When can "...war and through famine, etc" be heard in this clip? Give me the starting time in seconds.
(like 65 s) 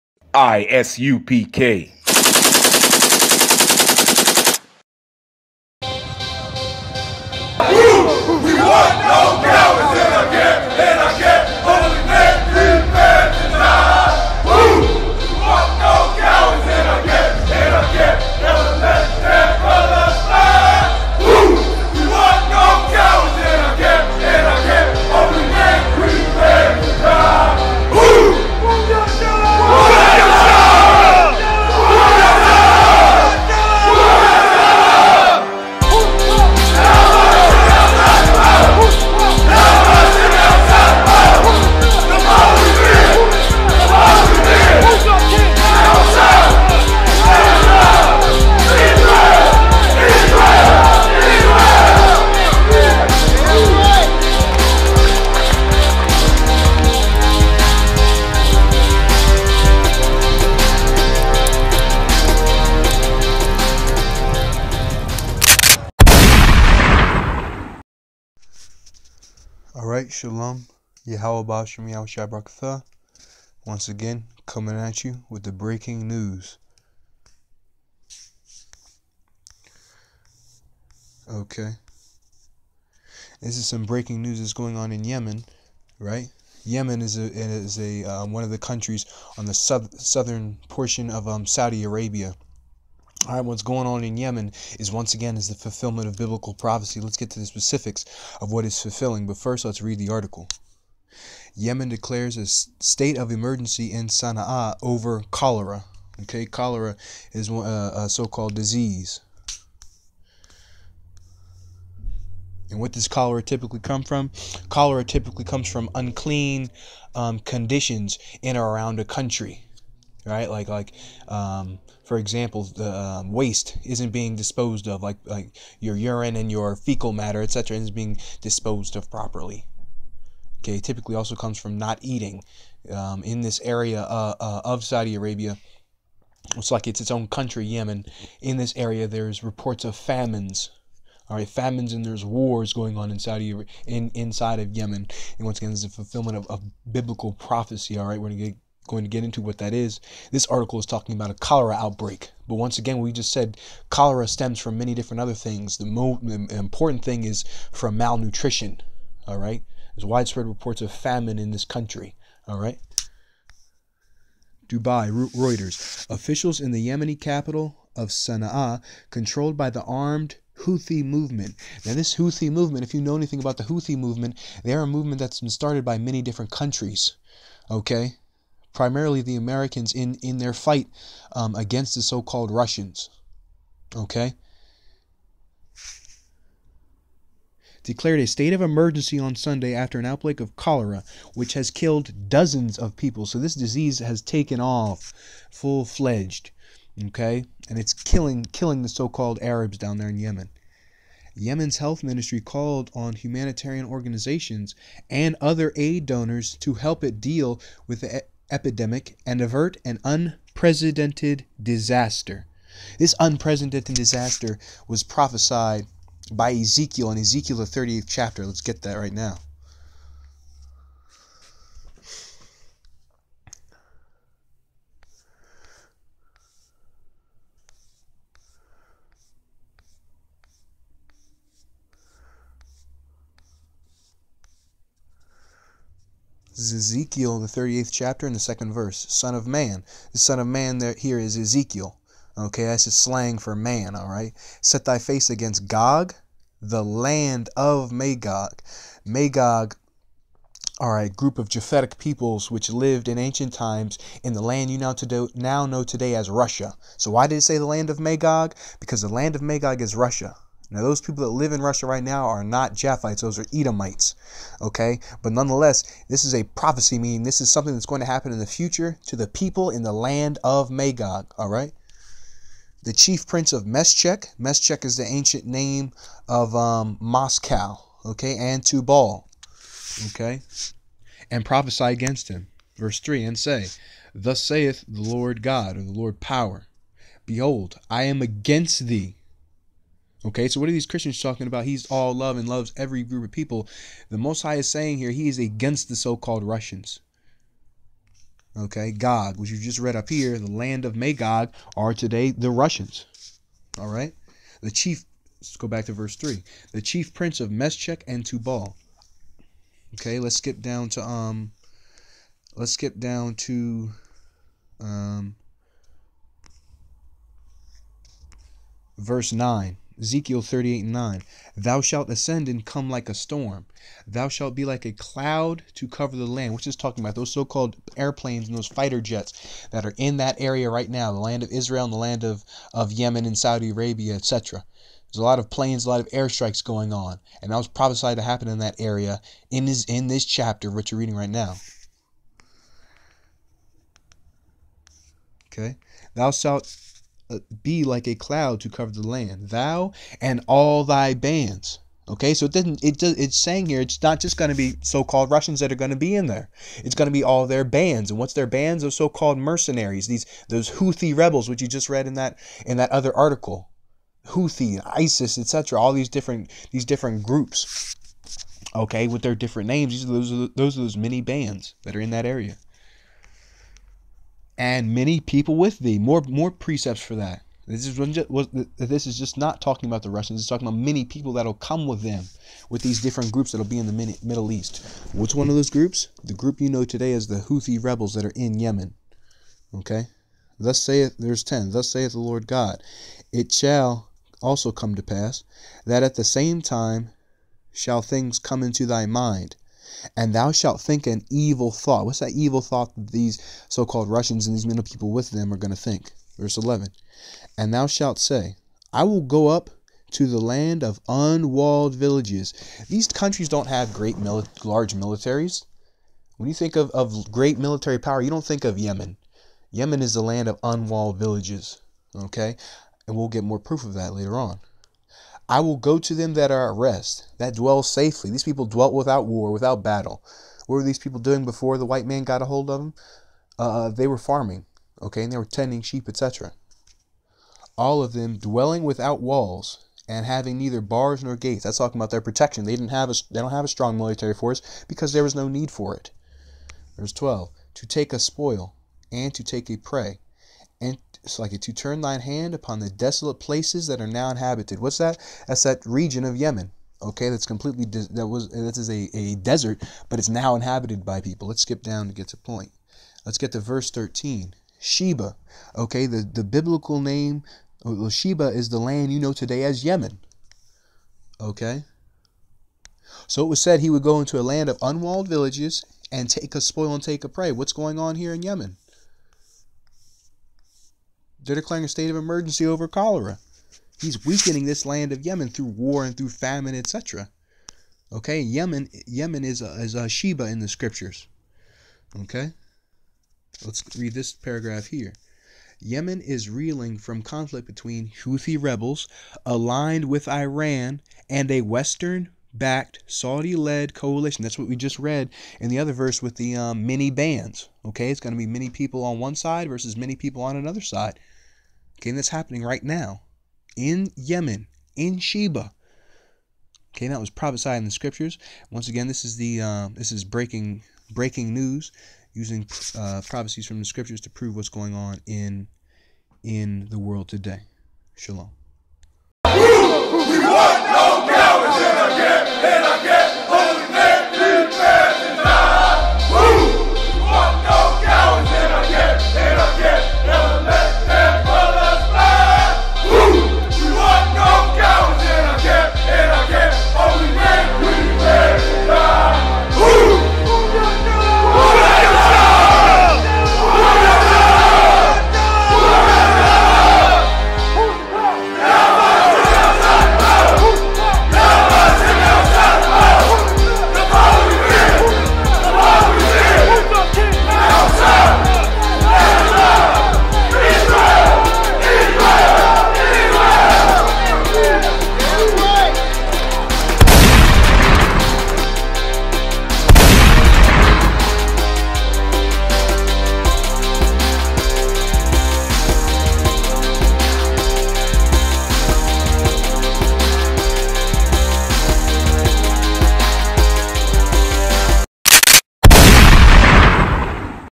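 485 s.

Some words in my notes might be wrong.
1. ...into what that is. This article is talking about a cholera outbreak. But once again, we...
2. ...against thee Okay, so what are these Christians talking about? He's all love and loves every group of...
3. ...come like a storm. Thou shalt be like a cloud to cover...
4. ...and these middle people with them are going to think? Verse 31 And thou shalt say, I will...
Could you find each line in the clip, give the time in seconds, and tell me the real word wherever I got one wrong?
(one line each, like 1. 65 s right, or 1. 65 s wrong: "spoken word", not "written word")
1. 149 s right
2. 288 s right
3. 322 s right
4. 404 s wrong: "11", not "31".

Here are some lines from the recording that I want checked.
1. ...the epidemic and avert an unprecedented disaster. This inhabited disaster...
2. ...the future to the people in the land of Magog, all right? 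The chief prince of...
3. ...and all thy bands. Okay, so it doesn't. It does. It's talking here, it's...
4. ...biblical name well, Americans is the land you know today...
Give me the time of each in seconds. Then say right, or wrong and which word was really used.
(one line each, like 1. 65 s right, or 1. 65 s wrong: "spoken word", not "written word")
1. 208 s wrong: "unprecedented", not "inhabited"
2. 268 s right
3. 350 s wrong: "saying", not "talking"
4. 466 s wrong: "Sheba", not "Americans".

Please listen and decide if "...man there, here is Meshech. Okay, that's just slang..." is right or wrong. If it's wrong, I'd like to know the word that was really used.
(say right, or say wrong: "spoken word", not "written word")
wrong: "Ezekiel", not "Meshech".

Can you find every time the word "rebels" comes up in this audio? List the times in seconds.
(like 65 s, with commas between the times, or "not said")
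361 s, 387 s, 498 s.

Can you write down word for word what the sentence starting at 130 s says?
Okay, typically also comes from not eating.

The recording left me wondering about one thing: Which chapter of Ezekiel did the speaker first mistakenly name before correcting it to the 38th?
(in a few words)
30th.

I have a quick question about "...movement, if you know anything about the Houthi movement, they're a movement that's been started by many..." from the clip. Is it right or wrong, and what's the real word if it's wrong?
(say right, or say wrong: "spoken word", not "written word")
right.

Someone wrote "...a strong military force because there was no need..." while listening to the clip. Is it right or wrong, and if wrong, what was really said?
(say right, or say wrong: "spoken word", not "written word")
right.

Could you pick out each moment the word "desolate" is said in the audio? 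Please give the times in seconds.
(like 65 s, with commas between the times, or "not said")
452 s.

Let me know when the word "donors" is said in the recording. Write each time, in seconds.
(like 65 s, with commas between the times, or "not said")
206 s.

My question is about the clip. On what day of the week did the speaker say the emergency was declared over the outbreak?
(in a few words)
Sunday.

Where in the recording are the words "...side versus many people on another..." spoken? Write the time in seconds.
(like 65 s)
509 s.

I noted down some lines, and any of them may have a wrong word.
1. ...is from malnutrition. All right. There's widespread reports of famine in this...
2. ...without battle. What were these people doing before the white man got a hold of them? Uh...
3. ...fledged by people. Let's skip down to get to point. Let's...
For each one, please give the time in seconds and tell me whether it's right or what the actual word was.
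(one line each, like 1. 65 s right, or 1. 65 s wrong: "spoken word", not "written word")
1. 157 s right
2. 429 s right
3. 460 s wrong: "inhabited", not "fledged".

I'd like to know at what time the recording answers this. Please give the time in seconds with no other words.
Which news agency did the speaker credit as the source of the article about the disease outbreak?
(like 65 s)
165 s.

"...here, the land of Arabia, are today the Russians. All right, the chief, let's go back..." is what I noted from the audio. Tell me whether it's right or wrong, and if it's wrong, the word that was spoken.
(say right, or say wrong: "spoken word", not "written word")
wrong: "Magog", not "Arabia".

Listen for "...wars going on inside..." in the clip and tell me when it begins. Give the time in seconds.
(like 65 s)
142 s.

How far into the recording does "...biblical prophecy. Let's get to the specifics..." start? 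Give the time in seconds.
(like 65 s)
96 s.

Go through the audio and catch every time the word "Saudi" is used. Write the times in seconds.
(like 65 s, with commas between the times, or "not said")
91 s, 134 s, 333 s, 503 s.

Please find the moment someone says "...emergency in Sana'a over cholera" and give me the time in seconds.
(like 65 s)
103 s.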